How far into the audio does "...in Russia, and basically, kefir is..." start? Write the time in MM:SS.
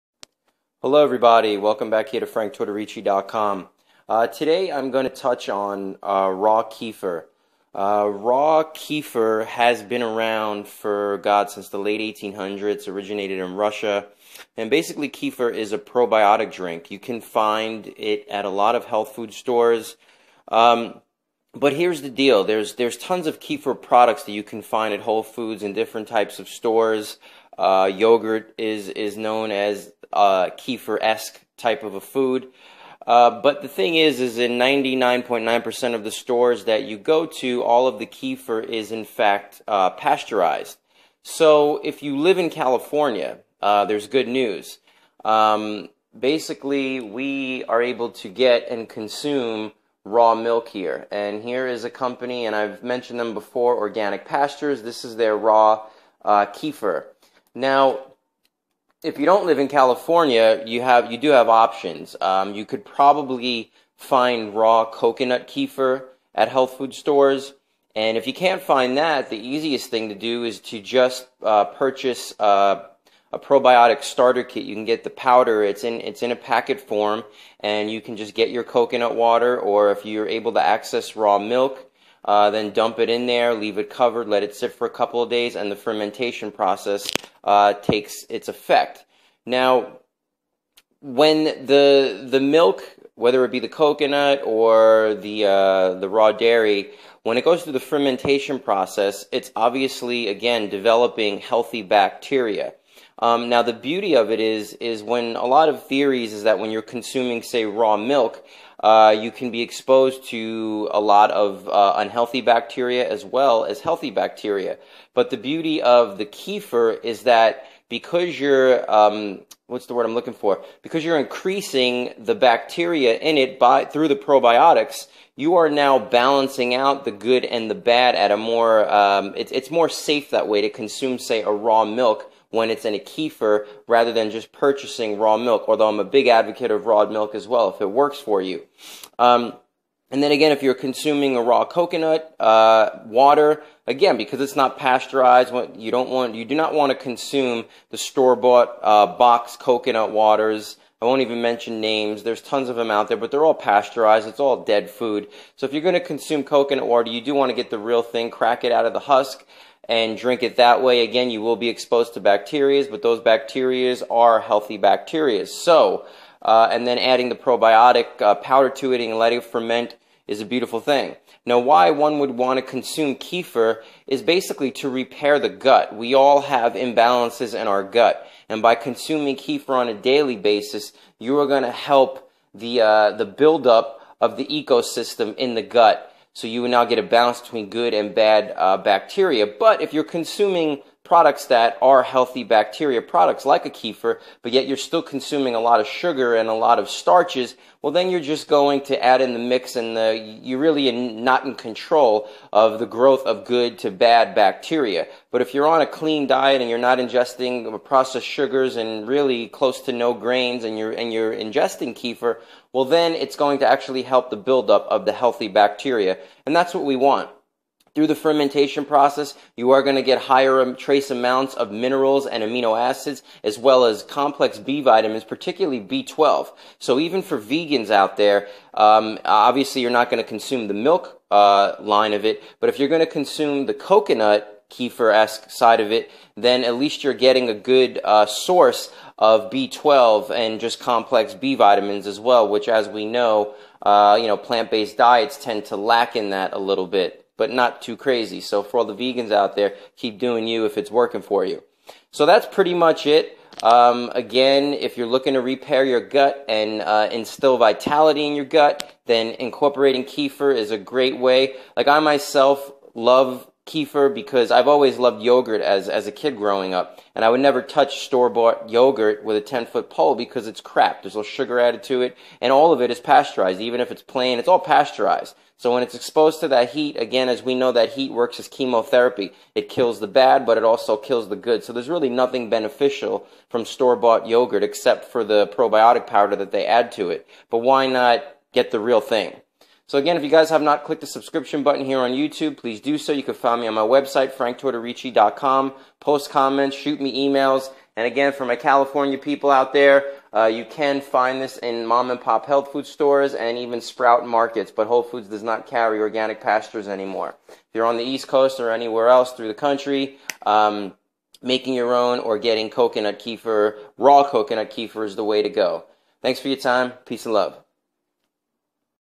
00:13.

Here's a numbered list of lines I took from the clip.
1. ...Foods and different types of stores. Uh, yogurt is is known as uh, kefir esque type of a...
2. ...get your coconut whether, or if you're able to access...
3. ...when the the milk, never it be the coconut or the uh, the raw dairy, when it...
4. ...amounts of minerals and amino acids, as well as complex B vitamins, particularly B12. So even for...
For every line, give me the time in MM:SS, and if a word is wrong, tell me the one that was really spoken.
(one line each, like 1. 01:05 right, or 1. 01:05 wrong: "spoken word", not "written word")
1. 00:25 right
2. 01:18 wrong: "water", not "whether"
3. 01:31 wrong: "whether", not "never"
4. 03:41 right.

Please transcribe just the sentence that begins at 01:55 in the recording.
But the beauty of the kefir is that because you're um, what's the word I'm looking for?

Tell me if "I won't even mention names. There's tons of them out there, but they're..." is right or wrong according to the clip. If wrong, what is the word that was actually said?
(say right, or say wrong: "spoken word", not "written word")
right.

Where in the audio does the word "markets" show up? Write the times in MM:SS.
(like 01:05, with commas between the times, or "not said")
05:04.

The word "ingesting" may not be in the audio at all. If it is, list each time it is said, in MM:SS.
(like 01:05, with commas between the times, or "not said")
03:26, 03:31.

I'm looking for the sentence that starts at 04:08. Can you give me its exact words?
So for all the vegans out there, keep doing you if it's working for you.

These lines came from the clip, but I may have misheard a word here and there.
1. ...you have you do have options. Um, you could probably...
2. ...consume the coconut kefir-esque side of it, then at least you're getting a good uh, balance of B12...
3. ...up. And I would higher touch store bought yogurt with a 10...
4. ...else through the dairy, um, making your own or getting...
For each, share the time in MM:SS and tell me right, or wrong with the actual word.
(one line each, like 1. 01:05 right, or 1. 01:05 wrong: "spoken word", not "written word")
1. 01:00 right
2. 03:53 wrong: "source", not "balance"
3. 04:26 wrong: "never", not "higher"
4. 05:09 wrong: "country", not "dairy".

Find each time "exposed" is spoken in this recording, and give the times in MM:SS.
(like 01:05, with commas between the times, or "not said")
01:49, 02:41, 04:35.